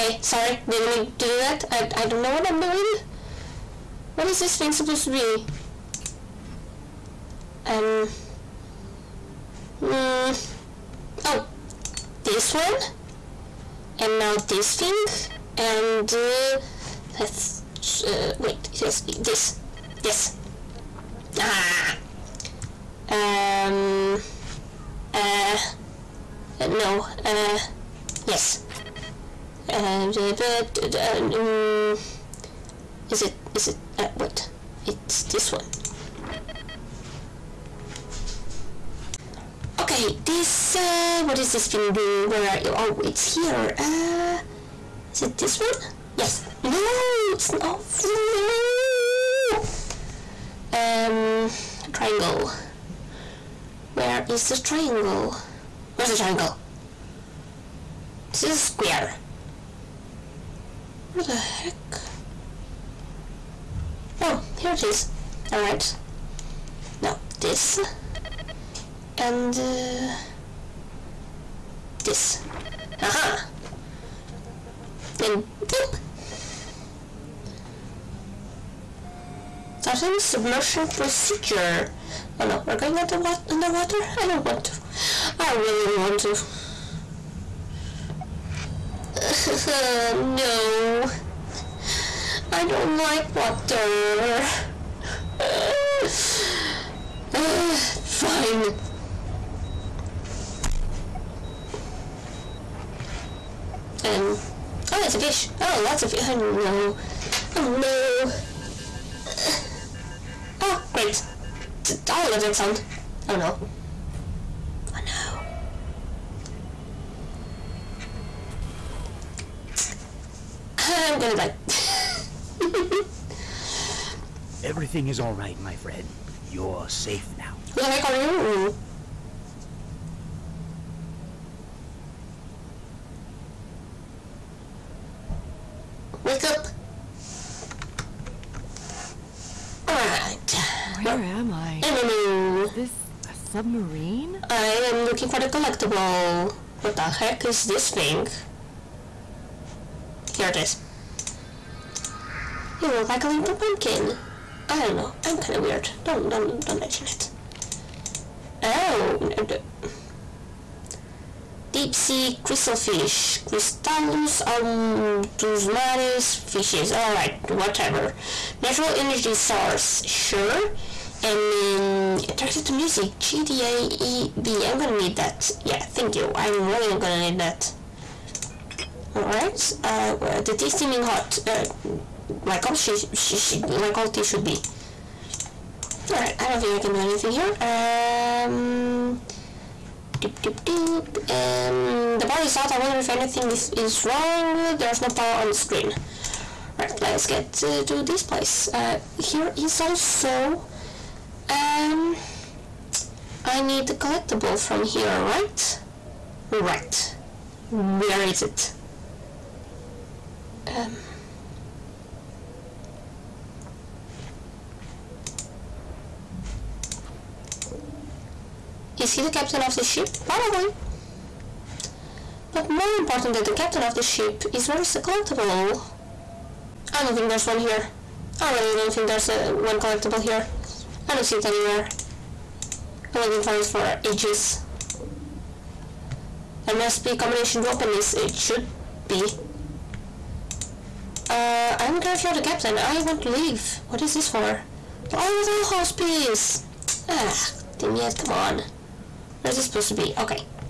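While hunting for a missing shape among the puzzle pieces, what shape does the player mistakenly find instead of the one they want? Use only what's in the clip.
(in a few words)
square.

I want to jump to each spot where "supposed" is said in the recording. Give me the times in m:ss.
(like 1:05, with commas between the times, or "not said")
0:04, 4:09.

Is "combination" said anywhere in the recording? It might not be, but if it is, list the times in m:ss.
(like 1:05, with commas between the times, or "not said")
3:57.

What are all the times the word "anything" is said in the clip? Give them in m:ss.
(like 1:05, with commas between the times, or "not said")
3:06, 3:13.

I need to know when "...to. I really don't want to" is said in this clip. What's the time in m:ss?
1:24.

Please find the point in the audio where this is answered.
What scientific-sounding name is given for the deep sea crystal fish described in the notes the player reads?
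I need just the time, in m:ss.
2:43.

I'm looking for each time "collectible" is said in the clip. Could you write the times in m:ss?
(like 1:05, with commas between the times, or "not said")
2:25, 3:23, 3:44, 3:49.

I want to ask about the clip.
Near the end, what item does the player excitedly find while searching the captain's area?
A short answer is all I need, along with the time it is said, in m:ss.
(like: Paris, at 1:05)
the dollhouse piece, at 4:05.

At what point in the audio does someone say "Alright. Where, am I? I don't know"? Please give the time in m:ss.
2:19.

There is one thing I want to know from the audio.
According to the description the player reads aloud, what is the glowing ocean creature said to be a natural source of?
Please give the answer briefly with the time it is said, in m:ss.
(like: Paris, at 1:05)
energy, at 2:48.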